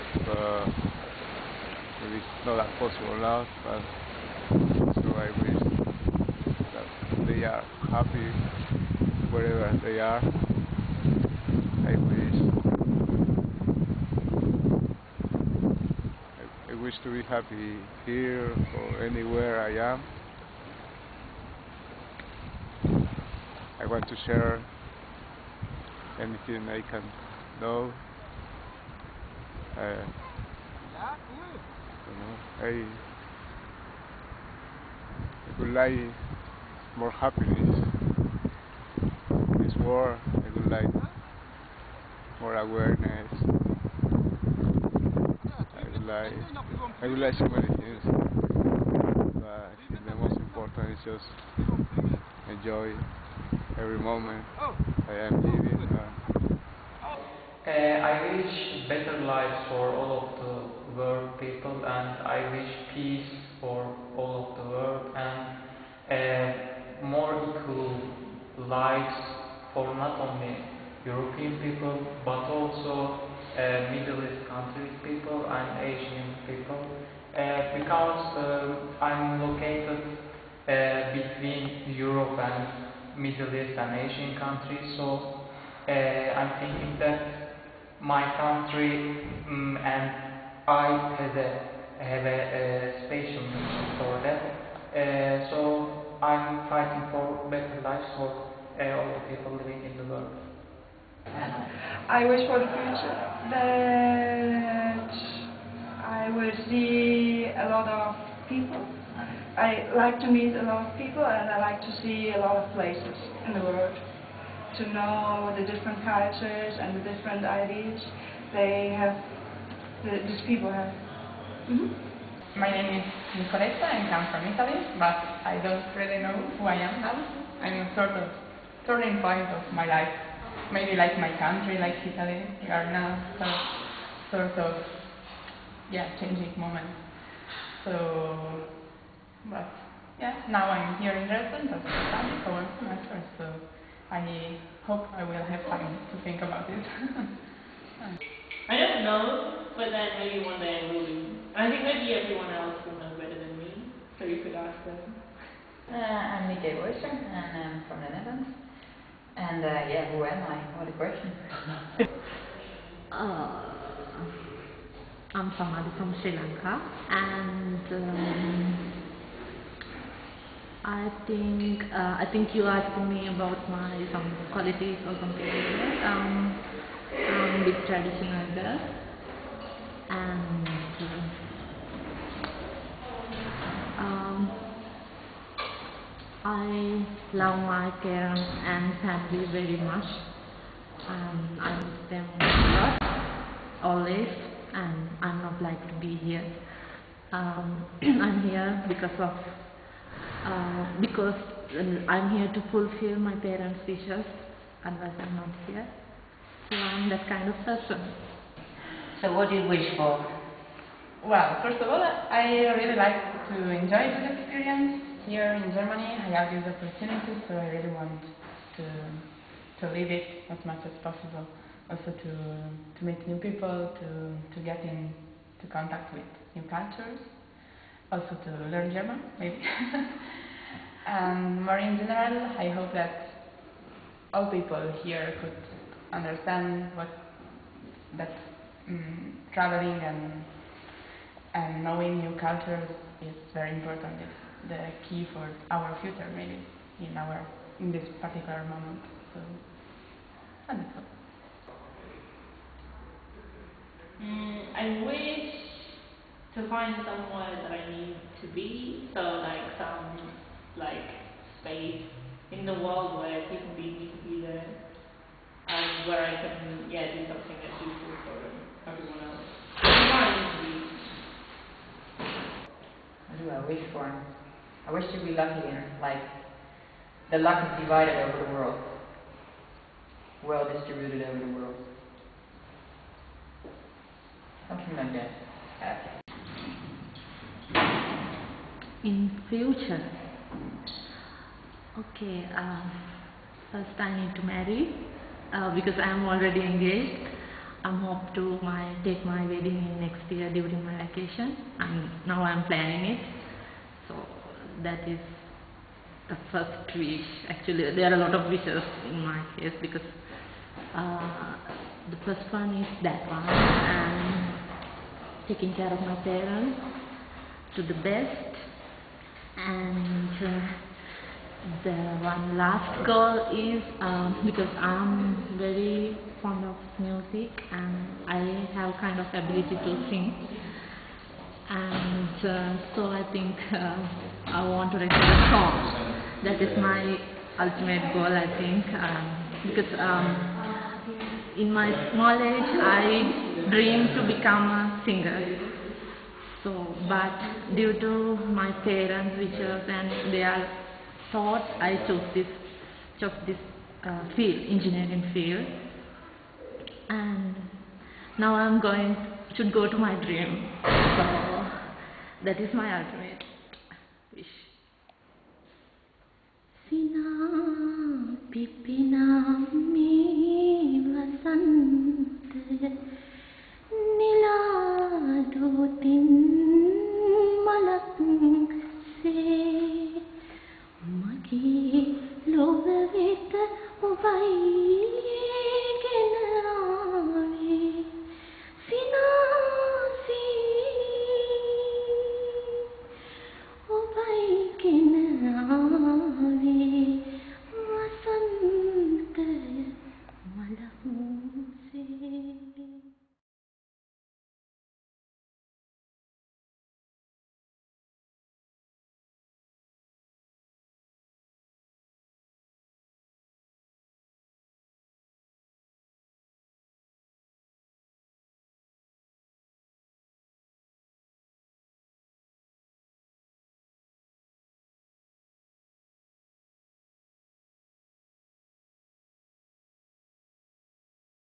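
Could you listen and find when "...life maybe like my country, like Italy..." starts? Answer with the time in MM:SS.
02:09.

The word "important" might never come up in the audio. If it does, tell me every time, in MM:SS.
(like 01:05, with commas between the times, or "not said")
00:50, 04:03.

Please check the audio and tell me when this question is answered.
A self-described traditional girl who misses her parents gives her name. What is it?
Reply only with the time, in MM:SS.
02:45.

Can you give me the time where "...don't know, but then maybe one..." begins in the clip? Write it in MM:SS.
02:28.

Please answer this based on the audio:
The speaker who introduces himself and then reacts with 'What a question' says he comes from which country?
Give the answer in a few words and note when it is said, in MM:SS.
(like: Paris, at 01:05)
The Netherlands, at 02:38.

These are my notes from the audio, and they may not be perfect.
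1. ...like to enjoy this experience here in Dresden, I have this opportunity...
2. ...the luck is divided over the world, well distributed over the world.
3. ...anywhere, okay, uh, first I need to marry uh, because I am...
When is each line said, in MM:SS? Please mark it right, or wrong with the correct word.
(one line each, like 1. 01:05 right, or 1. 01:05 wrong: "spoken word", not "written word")
1. 03:32 wrong: "Germany", not "Dresden"
2. 04:37 right
3. 04:49 wrong: "future", not "anywhere".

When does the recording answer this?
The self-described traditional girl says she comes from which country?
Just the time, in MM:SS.
02:46.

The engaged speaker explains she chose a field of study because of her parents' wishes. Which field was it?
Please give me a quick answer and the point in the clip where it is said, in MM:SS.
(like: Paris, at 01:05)
Engineering, at 05:54.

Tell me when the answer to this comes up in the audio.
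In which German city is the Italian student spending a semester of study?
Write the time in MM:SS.
02:21.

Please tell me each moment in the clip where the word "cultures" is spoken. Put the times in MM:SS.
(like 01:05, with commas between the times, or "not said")
01:56, 03:46, 04:02.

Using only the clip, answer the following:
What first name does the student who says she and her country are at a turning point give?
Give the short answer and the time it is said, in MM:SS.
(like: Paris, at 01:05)
Nicoletta, at 02:03.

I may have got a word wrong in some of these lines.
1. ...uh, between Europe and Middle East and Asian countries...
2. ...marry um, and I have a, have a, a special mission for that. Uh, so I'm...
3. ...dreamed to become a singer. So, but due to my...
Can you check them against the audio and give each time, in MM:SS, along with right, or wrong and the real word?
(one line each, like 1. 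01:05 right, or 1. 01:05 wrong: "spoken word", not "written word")
1. 01:19 right
2. 01:28 wrong: "country", not "marry"
3. 05:43 right.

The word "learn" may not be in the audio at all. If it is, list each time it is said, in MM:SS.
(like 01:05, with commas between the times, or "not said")
03:48.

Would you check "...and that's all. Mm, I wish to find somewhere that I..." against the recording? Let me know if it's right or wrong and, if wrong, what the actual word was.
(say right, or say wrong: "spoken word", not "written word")
right.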